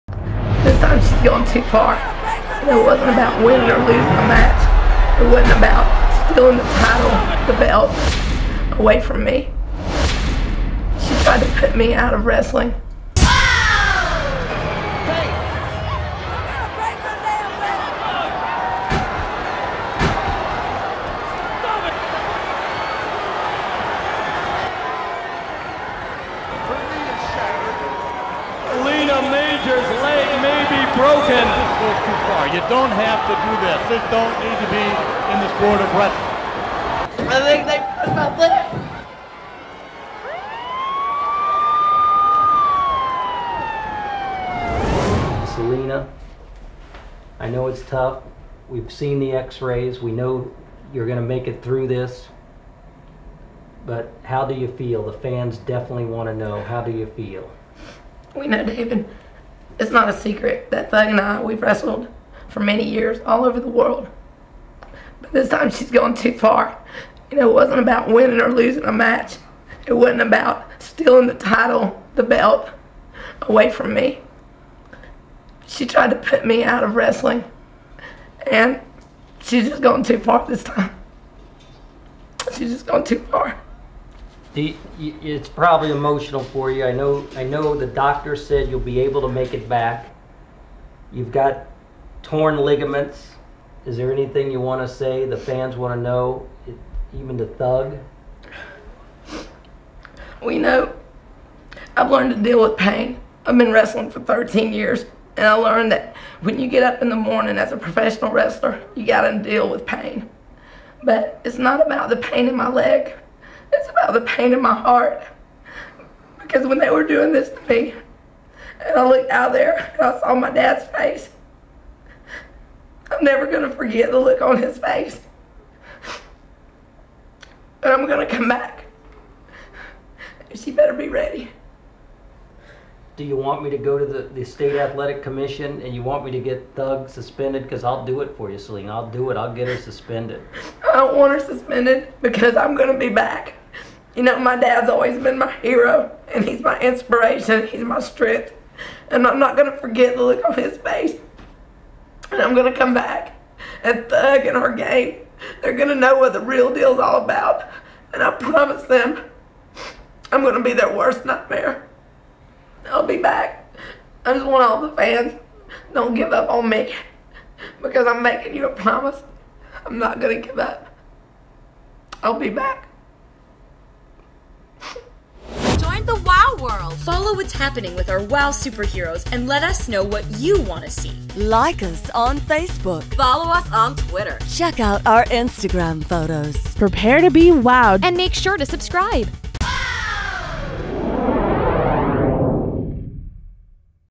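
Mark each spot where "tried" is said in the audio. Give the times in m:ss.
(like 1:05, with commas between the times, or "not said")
0:11, 1:15.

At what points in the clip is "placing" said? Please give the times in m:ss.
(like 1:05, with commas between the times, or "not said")
not said.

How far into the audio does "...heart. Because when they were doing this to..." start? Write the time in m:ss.
1:54.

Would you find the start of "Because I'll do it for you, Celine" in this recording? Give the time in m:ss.
2:17.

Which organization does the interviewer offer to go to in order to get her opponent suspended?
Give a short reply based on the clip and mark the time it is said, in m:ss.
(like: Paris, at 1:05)
state athletic commission, at 2:14.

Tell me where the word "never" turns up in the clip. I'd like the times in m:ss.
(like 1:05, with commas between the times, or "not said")
2:03.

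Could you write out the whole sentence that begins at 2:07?
But I'm going to come back.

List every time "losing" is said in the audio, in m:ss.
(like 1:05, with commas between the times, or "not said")
0:03, 1:08.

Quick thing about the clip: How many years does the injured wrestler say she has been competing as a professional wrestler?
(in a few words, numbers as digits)
13.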